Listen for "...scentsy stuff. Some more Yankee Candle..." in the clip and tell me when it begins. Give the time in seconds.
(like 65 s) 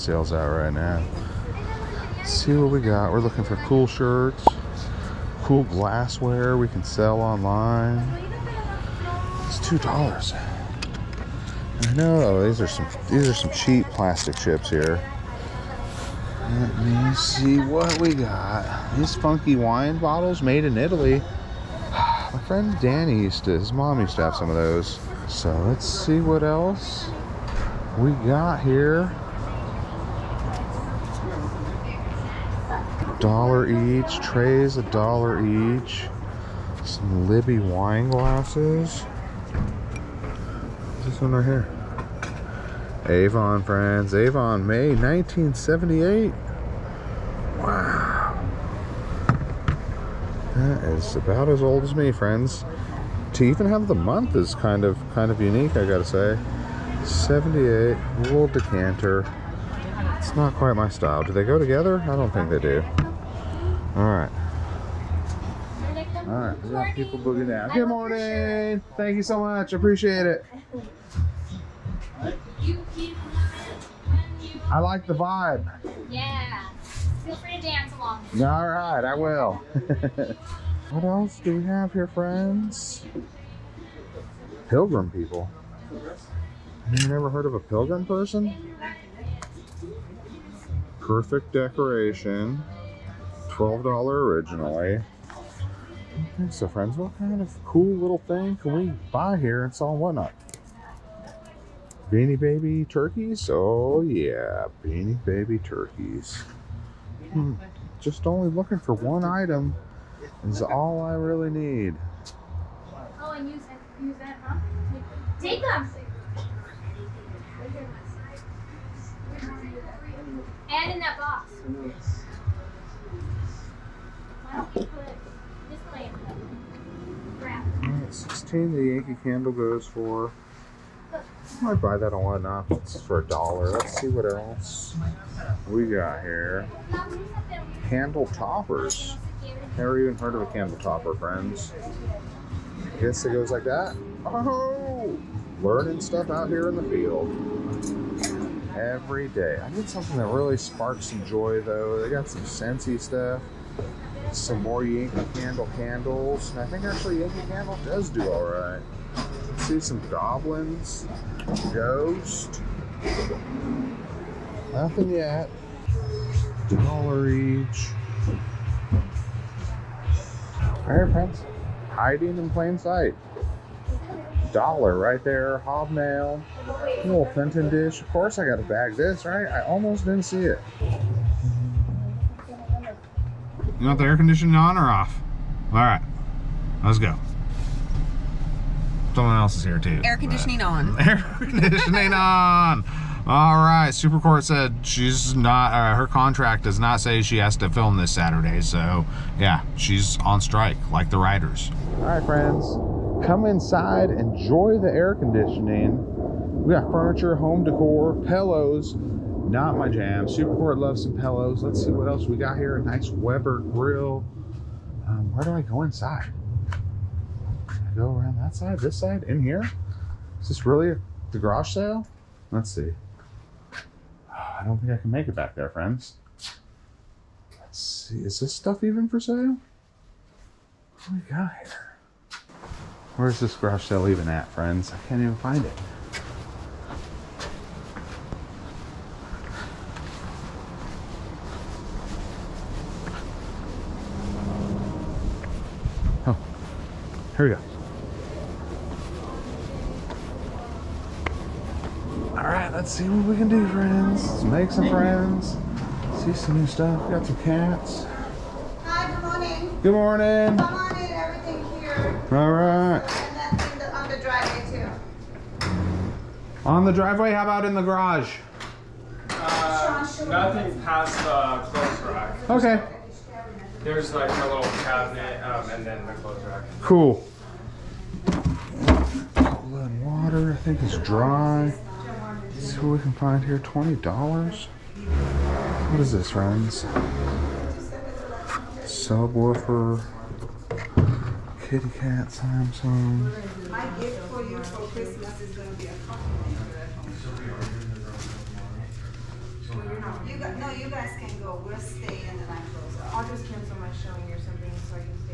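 152 s.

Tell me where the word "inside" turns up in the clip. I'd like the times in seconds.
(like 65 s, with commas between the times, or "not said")
203 s, 215 s.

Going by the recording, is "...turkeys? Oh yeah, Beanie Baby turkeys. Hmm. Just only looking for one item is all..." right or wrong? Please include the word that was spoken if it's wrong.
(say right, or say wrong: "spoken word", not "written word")
right.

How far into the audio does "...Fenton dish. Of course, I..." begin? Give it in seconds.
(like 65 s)
177 s.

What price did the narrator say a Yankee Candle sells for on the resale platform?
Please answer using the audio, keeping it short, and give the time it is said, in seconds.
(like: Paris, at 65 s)
16, at 128 s.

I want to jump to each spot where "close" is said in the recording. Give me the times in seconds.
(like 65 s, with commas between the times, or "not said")
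302 s.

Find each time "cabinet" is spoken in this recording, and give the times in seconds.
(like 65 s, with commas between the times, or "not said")
274 s.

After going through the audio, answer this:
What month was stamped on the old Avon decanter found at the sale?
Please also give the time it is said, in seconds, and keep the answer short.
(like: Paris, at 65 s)
May 1978, at 44 s.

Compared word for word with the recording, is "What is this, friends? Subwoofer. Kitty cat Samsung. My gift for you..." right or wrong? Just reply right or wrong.
right.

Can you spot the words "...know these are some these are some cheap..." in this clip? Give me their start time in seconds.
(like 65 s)
11 s.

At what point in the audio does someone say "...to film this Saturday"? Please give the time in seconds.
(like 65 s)
197 s.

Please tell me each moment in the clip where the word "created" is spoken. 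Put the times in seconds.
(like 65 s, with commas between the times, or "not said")
not said.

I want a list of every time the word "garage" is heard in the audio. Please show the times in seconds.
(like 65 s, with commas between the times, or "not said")
221 s, 233 s, 267 s.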